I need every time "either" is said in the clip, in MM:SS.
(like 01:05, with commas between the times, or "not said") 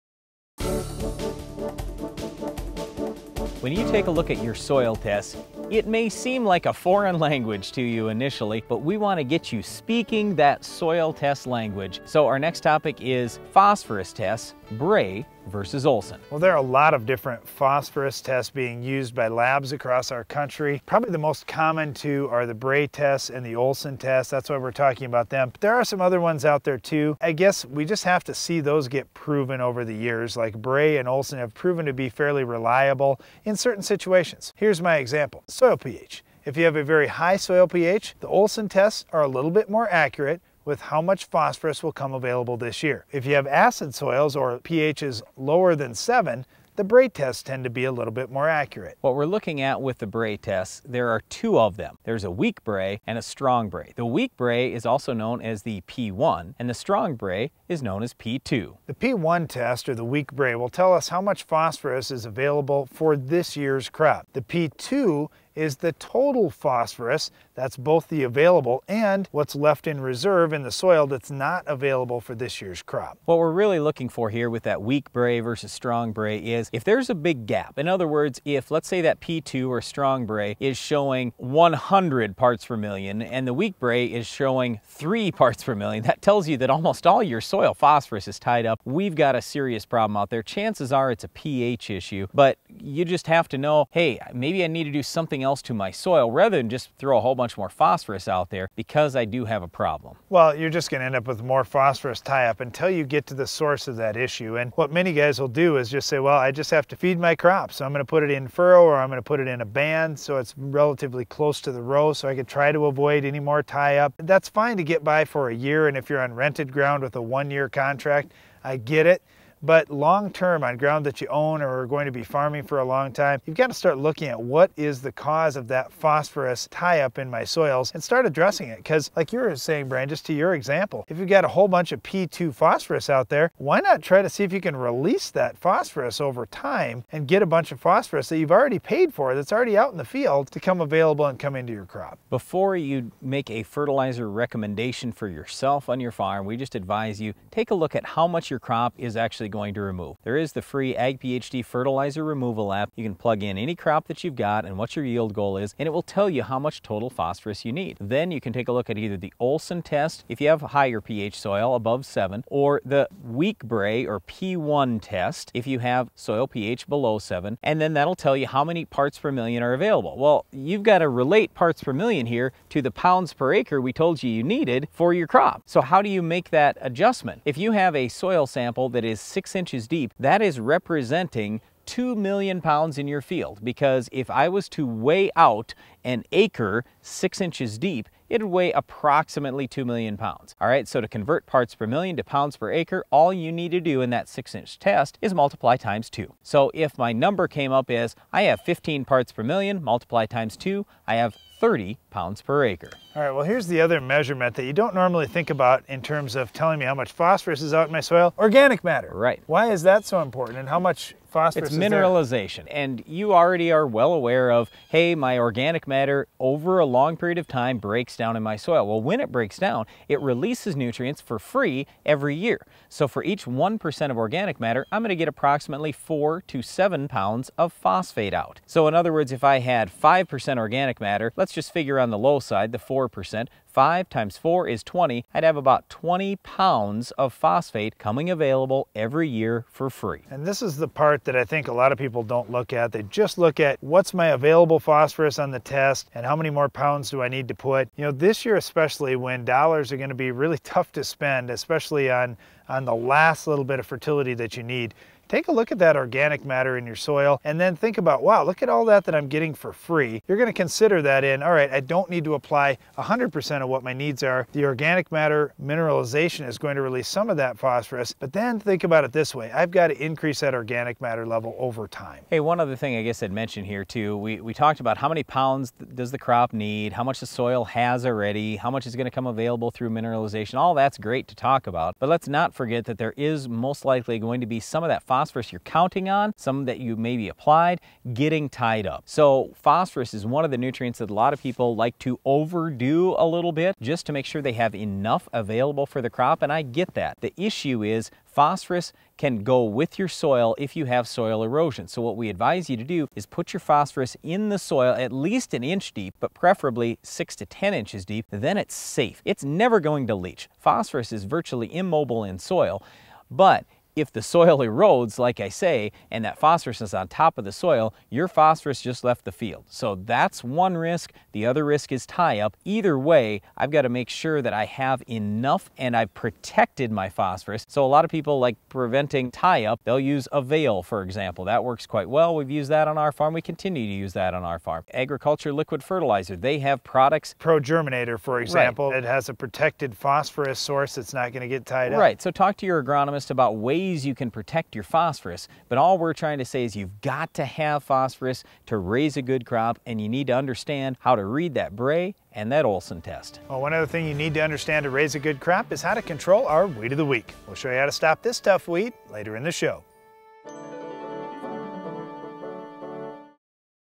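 02:38, 05:22.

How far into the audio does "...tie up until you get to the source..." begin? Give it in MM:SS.
01:42.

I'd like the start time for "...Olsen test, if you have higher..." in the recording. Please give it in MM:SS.
02:39.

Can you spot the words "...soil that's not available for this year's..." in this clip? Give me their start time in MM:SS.
01:10.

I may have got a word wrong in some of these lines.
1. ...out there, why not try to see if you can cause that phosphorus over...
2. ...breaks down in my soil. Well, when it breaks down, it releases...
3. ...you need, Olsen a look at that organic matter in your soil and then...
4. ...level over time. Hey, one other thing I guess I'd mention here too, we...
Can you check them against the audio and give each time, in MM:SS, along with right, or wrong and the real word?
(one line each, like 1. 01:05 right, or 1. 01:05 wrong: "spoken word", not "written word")
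1. 02:13 wrong: "release", not "cause"
2. 03:37 right
3. 04:14 wrong: "Take", not "Olsen"
4. 04:31 right.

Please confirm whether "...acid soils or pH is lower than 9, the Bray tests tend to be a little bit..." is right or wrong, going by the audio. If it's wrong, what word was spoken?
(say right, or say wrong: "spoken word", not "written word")
wrong: "7", not "9".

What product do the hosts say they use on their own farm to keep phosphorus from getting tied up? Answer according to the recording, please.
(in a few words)
AVAIL.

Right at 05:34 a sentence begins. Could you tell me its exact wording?
Agro-Culture liquid fertilizer, they have products.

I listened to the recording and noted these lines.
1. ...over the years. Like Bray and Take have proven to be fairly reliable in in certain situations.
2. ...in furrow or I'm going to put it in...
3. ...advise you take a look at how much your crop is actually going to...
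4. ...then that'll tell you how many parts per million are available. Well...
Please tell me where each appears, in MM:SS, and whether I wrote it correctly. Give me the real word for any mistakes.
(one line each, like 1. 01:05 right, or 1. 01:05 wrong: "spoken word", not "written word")
1. 00:29 wrong: "Olsen", not "Take"
2. 01:48 right
3. 02:26 right
4. 02:47 right.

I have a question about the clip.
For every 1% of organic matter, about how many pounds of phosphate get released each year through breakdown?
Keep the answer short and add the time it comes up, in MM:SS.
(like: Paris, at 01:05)
4 to 7 pounds, at 03:45.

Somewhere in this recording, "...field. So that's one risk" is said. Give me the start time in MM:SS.
05:19.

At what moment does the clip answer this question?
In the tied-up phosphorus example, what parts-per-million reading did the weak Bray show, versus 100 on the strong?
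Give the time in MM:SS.
01:24.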